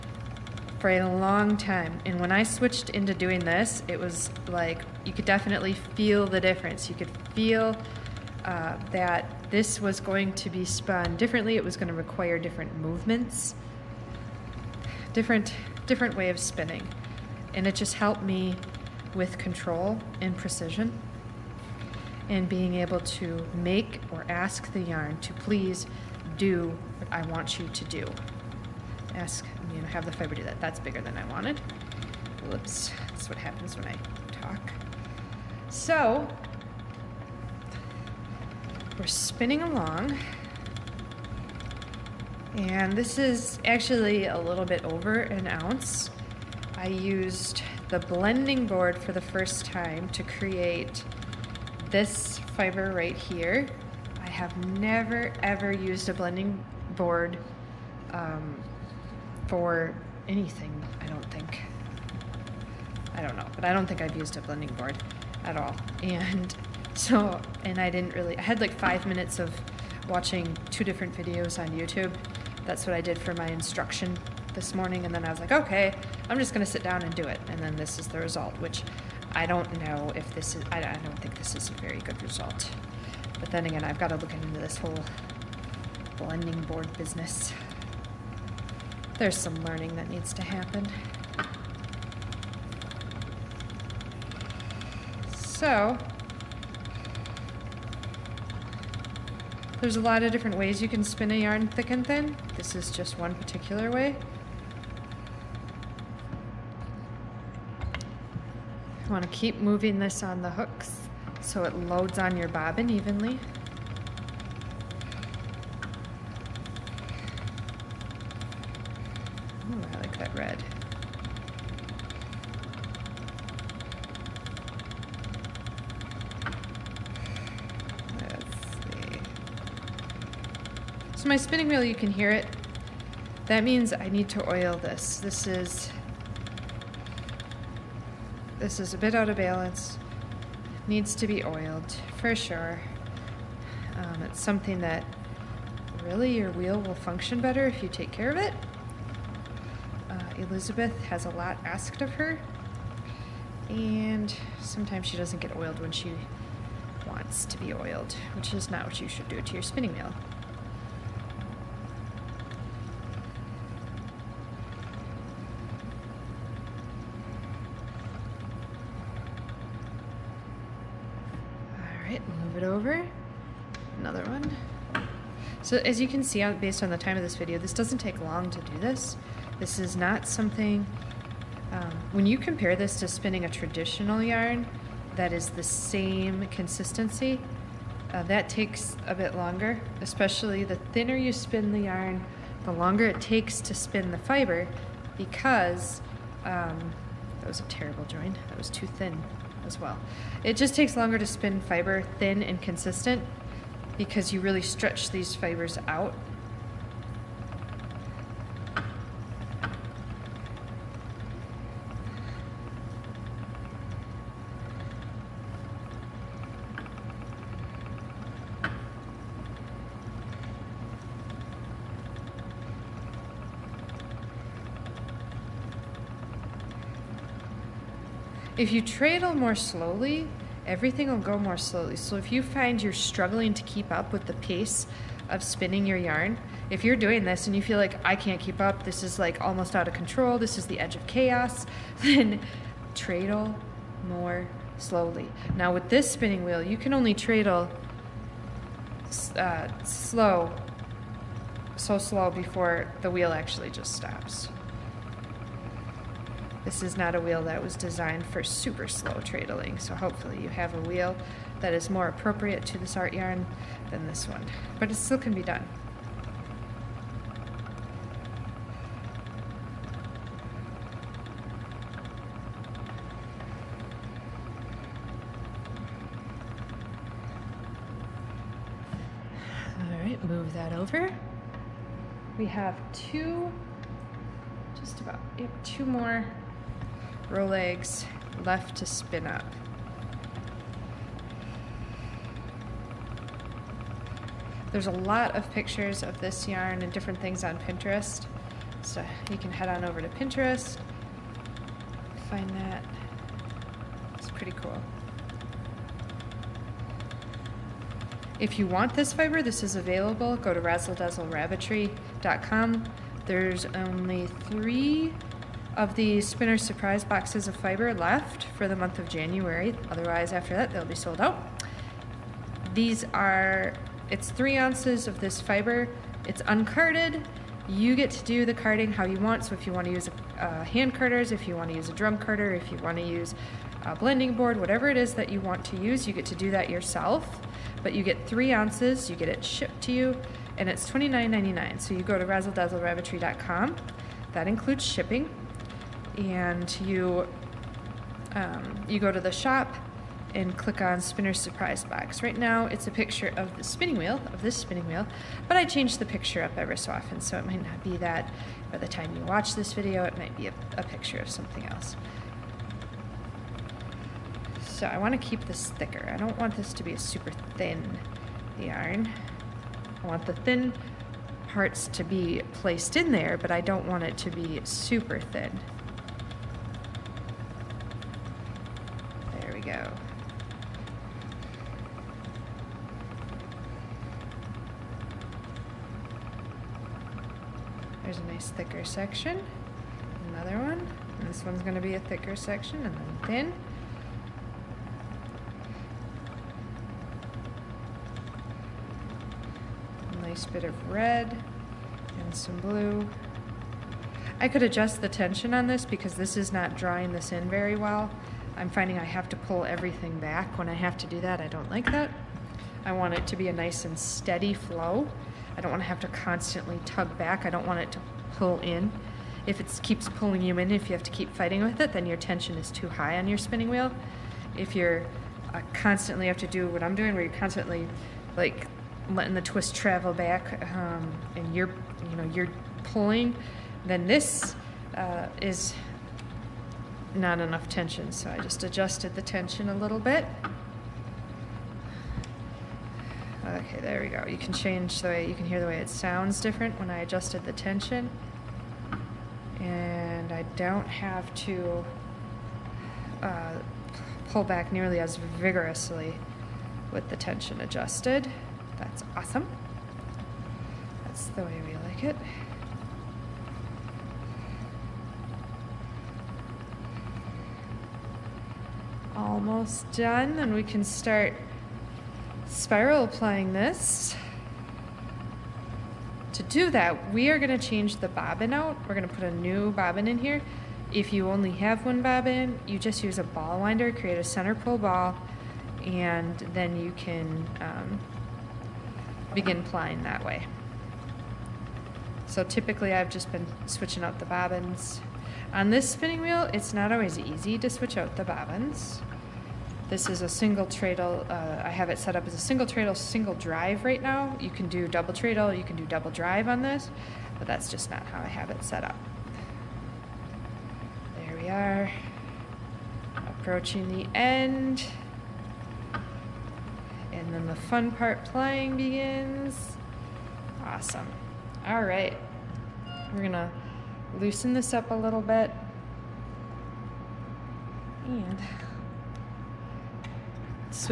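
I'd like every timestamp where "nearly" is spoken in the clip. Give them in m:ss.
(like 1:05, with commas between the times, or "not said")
7:34.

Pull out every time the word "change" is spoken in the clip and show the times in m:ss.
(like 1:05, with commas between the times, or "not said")
5:55, 7:24, 7:57.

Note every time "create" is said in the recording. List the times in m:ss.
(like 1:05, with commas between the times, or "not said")
0:50, 8:03.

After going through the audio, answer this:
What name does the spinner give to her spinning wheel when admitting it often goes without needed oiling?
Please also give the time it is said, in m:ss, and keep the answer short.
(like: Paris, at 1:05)
Elizabeth, at 2:30.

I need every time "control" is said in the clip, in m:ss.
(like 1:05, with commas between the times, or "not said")
0:19, 3:59.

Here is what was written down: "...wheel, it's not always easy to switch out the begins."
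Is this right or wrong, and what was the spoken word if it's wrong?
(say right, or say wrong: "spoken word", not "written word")
wrong: "bobbins", not "begins".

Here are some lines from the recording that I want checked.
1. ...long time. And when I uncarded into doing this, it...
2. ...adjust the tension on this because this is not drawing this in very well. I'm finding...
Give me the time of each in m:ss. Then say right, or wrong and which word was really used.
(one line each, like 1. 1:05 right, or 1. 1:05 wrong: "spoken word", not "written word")
1. 0:01 wrong: "switched", not "uncarded"
2. 6:44 right.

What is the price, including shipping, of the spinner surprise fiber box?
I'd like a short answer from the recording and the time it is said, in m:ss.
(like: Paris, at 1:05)
$29.99, at 5:40.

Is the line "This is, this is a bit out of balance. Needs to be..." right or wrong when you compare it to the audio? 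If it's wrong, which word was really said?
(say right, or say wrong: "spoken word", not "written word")
right.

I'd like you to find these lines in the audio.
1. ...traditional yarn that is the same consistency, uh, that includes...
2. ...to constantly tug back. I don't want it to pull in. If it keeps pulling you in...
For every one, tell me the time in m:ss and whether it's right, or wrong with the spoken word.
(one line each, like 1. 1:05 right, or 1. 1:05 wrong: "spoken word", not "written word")
1. 3:03 wrong: "takes", not "includes"
2. 6:56 right.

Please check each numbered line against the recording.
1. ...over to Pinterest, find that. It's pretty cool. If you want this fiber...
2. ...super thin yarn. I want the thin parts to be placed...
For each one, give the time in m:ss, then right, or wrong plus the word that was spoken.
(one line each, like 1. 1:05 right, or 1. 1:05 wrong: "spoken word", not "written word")
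1. 4:59 right
2. 6:06 right.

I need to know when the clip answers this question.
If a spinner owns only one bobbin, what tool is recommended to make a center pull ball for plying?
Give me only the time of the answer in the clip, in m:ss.
8:03.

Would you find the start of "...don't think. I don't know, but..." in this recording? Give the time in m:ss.
1:01.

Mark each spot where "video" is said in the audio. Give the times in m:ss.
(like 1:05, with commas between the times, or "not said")
1:11, 2:57, 5:59.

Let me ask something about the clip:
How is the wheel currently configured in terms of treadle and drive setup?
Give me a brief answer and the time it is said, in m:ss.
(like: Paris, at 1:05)
Single treadle, single drive, at 8:22.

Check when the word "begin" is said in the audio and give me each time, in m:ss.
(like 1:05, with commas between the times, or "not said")
8:09, 8:38.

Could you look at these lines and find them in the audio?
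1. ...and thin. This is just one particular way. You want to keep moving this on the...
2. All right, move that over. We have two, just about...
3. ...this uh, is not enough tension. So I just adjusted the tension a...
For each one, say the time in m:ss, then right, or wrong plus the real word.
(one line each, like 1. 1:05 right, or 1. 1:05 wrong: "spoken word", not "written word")
1. 1:41 right
2. 4:39 right
3. 7:14 right.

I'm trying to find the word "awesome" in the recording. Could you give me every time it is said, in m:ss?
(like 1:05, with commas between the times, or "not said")
7:39, 8:40.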